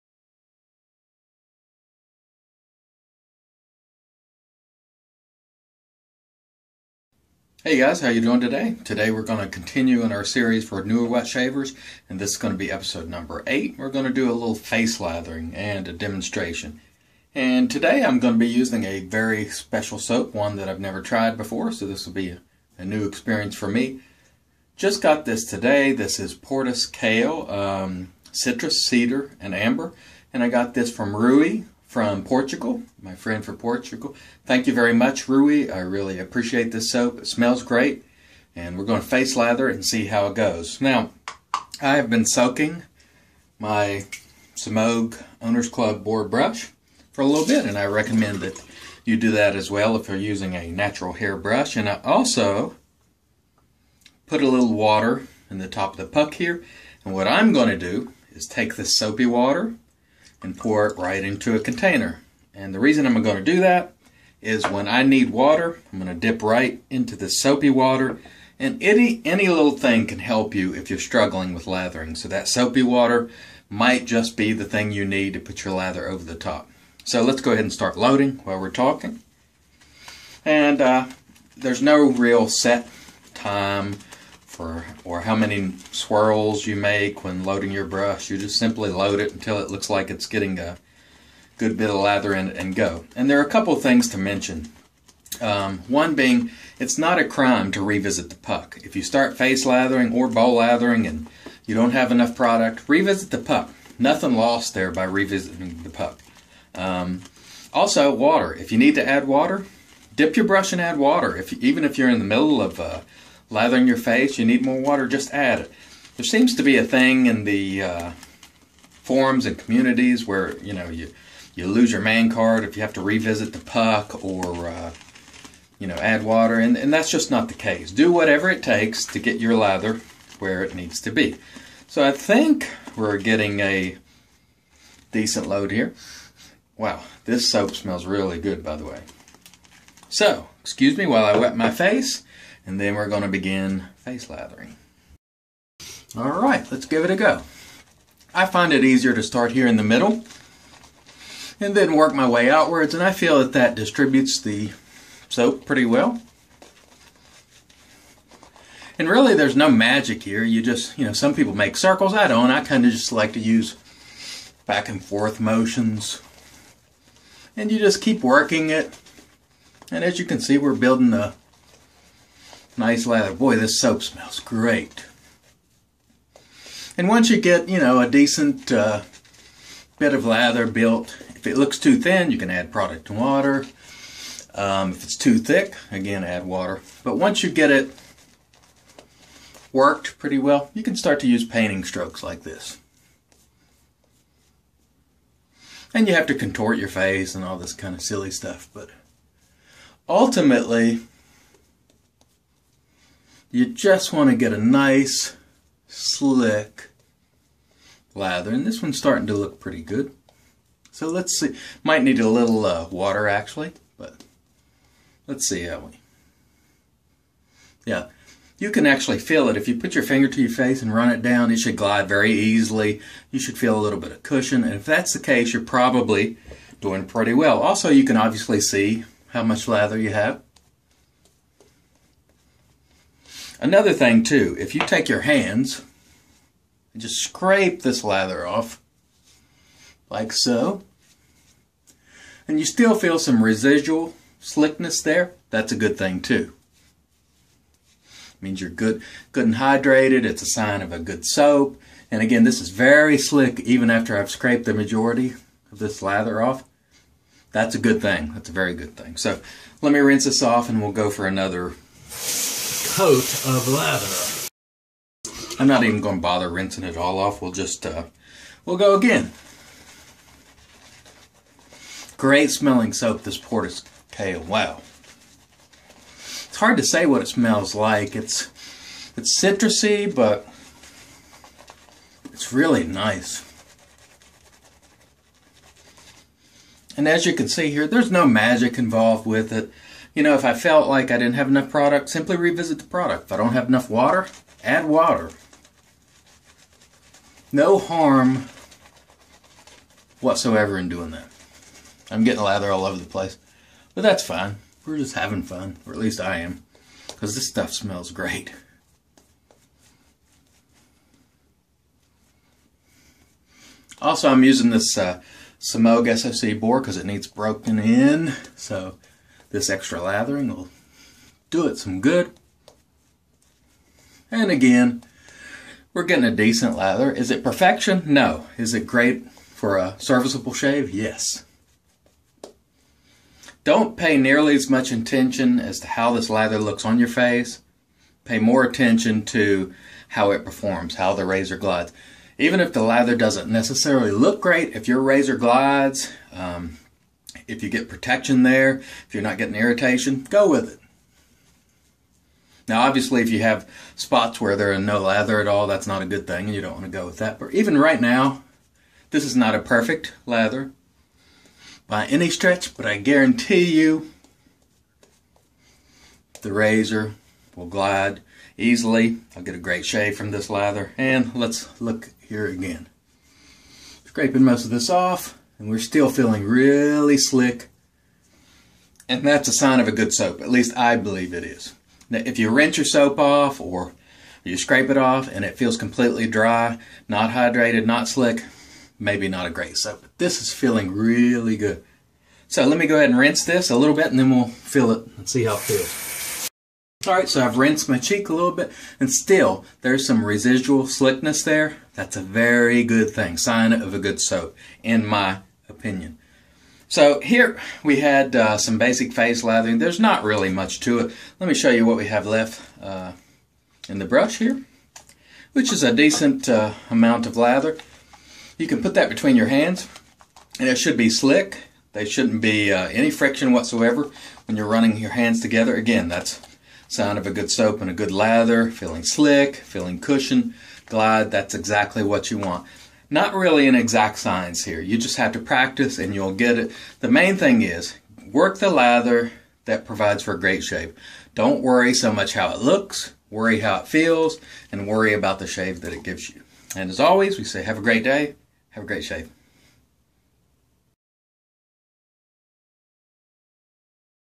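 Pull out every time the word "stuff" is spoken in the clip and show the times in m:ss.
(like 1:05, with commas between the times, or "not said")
3:18, 5:07.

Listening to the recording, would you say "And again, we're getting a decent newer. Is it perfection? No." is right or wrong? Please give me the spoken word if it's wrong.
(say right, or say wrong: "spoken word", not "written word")
wrong: "lather", not "newer".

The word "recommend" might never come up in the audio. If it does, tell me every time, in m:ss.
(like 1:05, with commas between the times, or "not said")
0:47.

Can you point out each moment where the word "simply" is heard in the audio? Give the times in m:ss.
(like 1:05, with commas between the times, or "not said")
1:28, 4:52.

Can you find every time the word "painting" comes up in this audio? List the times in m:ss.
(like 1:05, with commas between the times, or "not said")
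3:11.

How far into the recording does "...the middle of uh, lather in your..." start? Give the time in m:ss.
1:52.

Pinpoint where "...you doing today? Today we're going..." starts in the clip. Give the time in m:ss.
0:08.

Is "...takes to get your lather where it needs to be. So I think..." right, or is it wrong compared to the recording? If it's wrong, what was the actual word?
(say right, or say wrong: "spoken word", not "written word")
right.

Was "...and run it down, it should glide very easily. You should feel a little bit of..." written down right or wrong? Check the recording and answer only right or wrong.
right.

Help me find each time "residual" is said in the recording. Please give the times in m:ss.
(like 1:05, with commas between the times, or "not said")
4:03, 6:40.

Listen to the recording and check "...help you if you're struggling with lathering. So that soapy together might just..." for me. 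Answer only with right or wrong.
wrong.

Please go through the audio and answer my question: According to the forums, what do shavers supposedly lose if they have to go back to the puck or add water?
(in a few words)
man card.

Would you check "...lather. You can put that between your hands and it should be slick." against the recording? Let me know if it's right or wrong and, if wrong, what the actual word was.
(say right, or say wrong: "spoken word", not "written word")
right.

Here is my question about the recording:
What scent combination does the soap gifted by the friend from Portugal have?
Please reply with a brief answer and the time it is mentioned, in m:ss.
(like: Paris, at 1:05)
Citrus, Cedar, and Amber, at 0:28.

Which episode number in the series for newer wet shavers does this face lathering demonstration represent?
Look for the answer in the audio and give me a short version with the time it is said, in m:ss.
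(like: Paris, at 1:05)
8, at 0:12.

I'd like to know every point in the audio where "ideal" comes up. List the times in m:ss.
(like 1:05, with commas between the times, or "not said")
not said.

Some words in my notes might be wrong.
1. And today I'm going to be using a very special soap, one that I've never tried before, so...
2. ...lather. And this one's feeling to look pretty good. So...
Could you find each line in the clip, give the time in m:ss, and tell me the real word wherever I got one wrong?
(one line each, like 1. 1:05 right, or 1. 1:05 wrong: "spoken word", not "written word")
1. 0:17 right
2. 3:28 wrong: "starting", not "feeling".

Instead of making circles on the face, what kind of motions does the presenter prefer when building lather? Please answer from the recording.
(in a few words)
back and forth motions.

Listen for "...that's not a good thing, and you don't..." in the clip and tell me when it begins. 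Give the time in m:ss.
5:55.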